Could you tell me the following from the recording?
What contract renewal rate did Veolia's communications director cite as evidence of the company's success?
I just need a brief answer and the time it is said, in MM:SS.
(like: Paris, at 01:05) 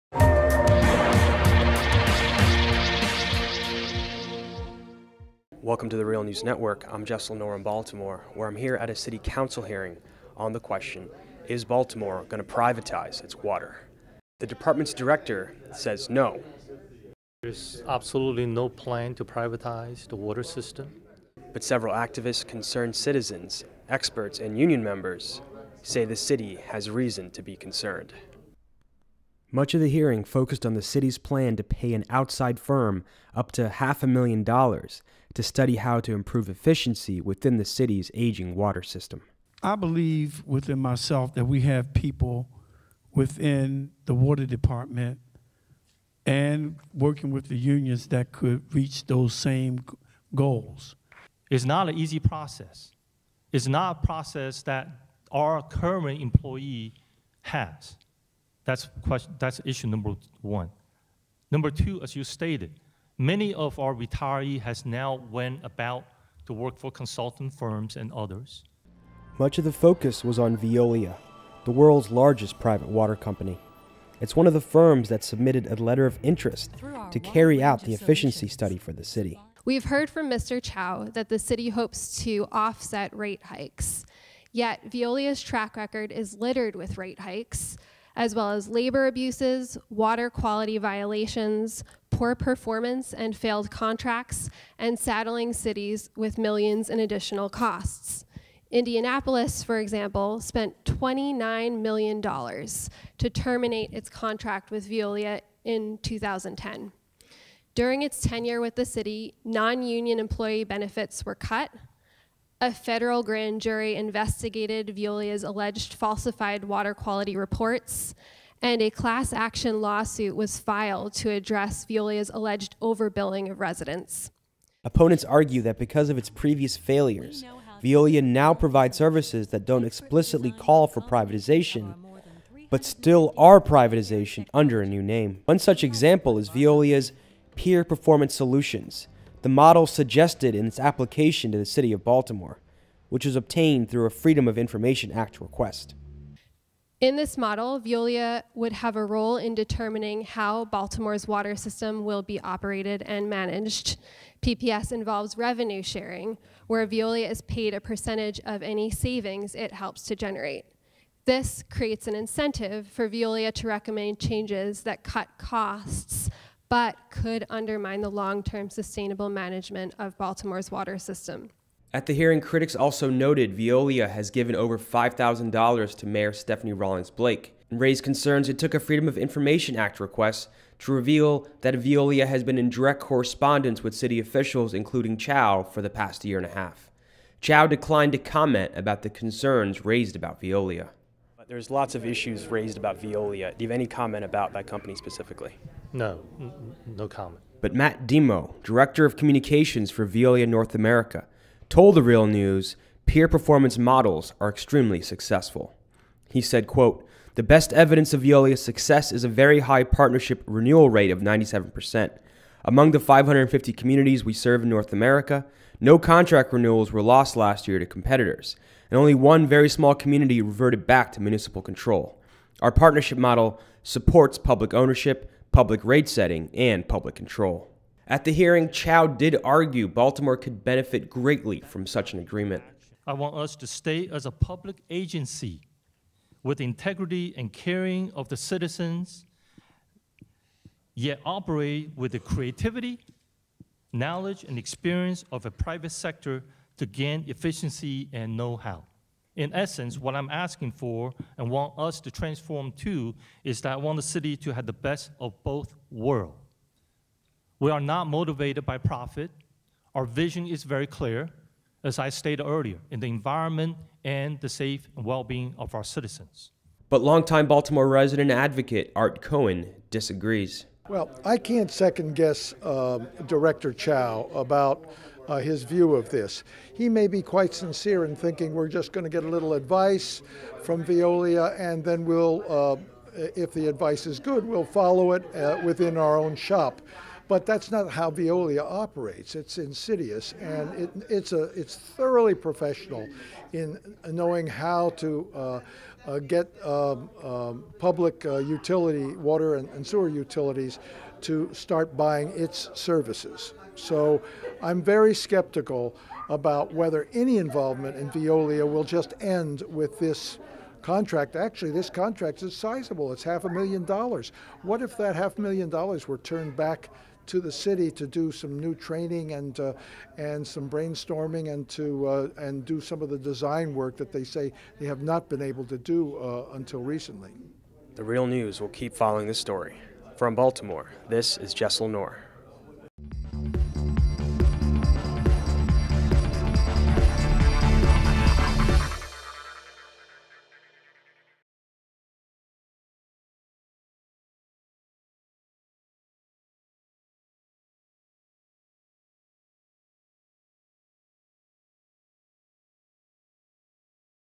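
97%, at 03:31.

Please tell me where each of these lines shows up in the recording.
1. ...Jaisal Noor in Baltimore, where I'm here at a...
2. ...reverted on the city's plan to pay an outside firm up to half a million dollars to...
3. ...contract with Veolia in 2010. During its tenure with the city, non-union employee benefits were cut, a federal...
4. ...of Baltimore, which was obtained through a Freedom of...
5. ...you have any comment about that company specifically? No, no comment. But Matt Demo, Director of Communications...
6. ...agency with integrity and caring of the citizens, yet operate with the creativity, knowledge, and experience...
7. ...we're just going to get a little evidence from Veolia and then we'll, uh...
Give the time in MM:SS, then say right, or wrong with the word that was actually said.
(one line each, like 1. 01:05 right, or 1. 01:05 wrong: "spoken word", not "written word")
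1. 00:07 right
2. 00:30 wrong: "focused", not "reverted"
3. 01:44 right
4. 02:21 right
5. 03:13 right
6. 03:54 right
7. 04:38 wrong: "advice", not "evidence".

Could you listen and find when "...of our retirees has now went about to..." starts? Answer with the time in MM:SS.
01:03.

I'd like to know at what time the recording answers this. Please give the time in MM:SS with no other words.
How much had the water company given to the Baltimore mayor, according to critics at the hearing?
02:54.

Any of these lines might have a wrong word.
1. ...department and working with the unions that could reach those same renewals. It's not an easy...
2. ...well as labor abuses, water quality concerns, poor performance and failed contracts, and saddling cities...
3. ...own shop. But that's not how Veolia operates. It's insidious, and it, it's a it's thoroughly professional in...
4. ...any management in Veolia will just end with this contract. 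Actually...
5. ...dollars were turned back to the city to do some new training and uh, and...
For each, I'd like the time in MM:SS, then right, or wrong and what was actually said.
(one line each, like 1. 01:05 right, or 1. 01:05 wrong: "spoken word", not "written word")
1. 00:44 wrong: "goals", not "renewals"
2. 01:28 wrong: "violations", not "concerns"
3. 04:46 right
4. 05:07 wrong: "involvement", not "management"
5. 05:15 right.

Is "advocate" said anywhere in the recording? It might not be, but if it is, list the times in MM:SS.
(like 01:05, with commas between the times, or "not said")
04:28.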